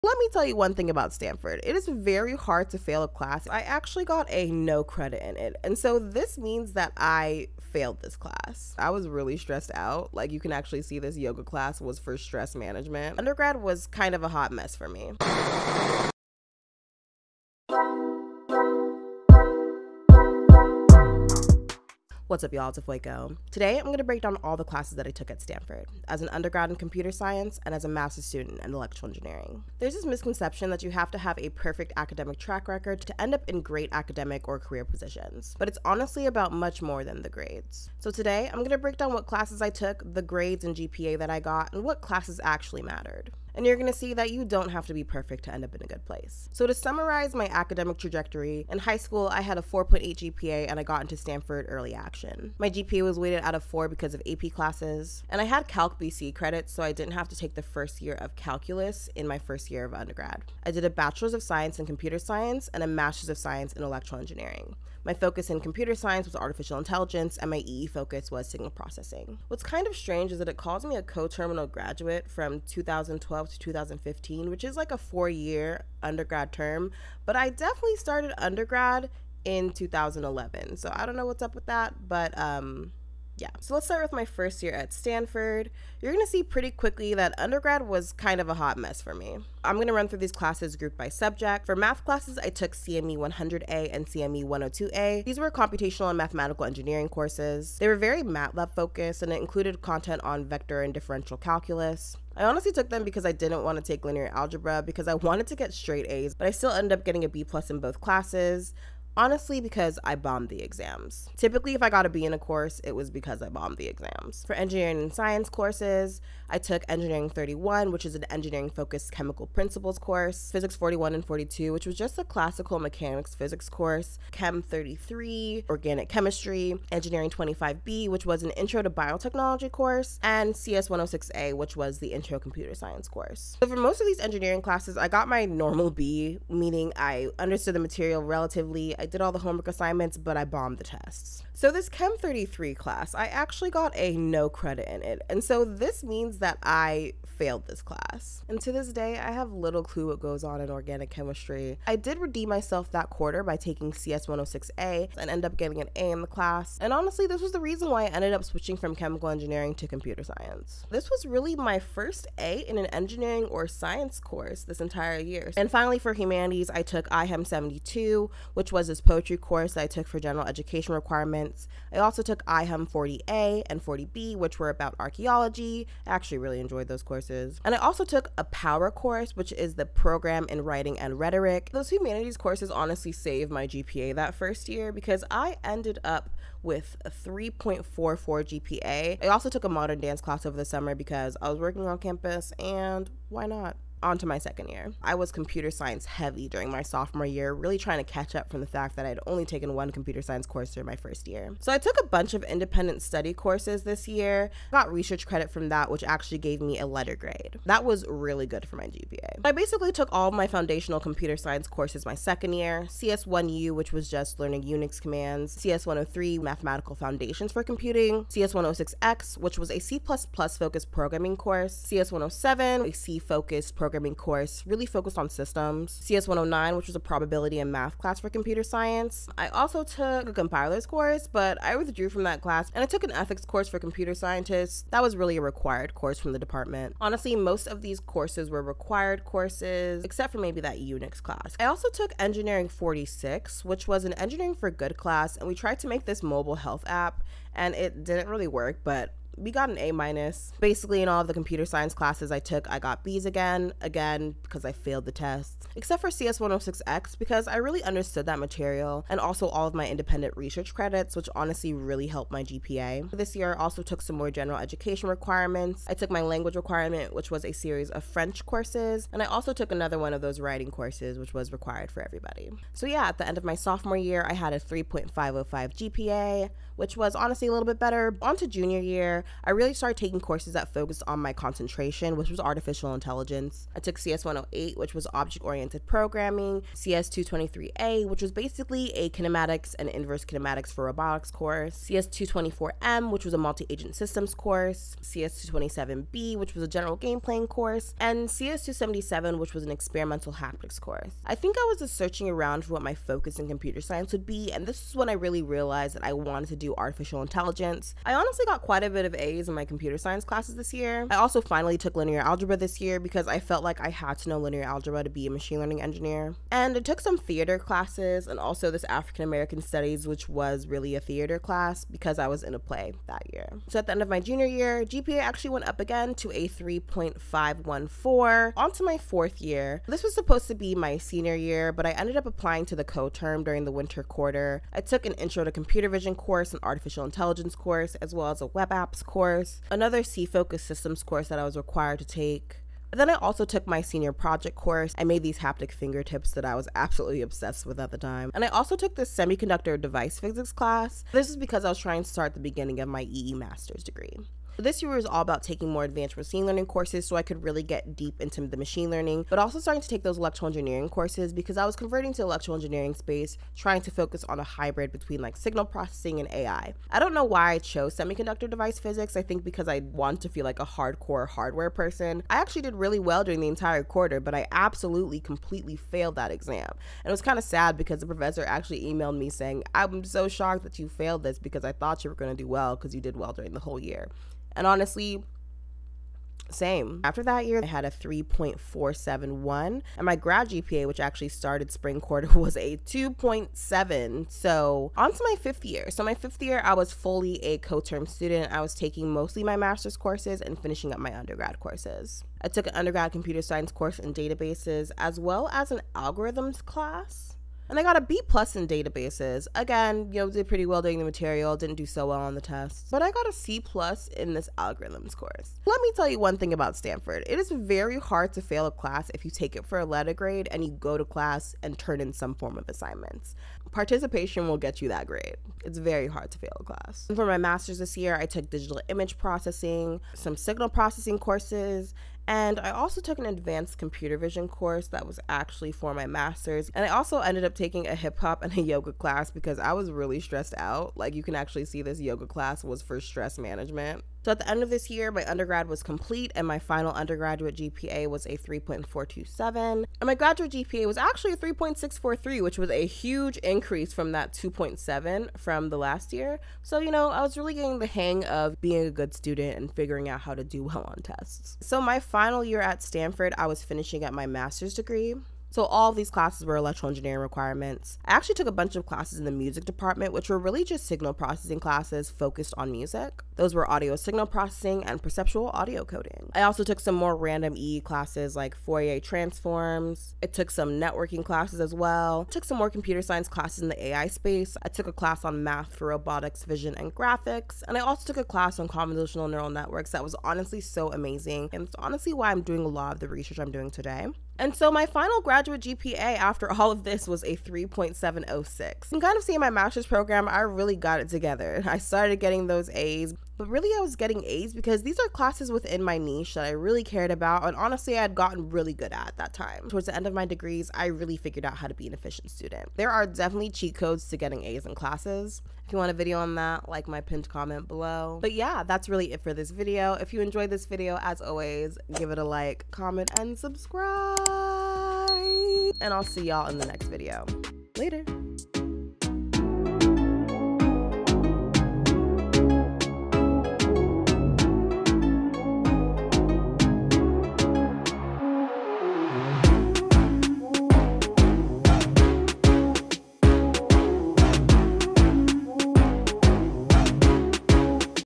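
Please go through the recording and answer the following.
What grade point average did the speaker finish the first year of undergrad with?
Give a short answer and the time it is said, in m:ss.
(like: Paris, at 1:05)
3.44, at 3:07.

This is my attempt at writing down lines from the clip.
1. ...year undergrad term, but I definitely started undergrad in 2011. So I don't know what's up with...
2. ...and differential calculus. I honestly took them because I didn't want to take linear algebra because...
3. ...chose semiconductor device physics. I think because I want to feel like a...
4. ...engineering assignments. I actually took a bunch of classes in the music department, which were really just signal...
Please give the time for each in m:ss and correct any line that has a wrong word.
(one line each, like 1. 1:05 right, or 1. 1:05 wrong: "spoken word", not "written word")
1. 1:15 right
2. 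1:40 right
3. 6:07 right
4. 7:46 wrong: "requirements", not "assignments".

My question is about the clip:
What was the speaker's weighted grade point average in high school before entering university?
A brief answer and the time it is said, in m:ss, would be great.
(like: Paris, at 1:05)
4.8, at 0:49.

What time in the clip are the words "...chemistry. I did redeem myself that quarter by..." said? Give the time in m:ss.
2:31.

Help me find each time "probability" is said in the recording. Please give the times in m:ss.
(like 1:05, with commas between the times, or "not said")
3:46.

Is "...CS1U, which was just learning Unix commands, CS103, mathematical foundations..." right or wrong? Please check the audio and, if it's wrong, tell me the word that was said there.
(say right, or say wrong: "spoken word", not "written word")
right.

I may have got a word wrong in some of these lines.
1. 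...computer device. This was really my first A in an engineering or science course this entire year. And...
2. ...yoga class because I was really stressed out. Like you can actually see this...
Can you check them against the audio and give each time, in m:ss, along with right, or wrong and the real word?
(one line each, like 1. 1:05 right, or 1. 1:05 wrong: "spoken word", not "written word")
1. 2:39 wrong: "science", not "device"
2. 7:18 right.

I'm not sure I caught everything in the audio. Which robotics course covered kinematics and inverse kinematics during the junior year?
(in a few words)
CS 223A.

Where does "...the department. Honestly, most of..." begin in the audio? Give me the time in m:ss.
3:56.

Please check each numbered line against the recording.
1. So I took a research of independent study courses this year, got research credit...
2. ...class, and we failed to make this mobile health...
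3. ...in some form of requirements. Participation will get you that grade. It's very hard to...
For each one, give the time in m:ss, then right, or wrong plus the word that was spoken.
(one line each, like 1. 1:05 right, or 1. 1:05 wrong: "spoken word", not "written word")
1. 3:21 wrong: "bunch", not "research"
2. 4:04 wrong: "tried", not "failed"
3. 7:02 wrong: "assignments", not "requirements".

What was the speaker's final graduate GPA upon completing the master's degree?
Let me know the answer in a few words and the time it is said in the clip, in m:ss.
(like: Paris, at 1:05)
3.706, at 8:17.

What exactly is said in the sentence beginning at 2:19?
I did all the homework assignments, but I bombed the tests.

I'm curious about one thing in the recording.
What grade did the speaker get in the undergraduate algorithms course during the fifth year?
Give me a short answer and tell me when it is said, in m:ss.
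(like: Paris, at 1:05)
C plus, at 6:53.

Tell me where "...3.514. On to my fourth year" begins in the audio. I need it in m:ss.
5:26.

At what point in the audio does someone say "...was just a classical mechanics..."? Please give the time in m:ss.
2:01.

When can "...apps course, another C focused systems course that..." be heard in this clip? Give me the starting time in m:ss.
5:38.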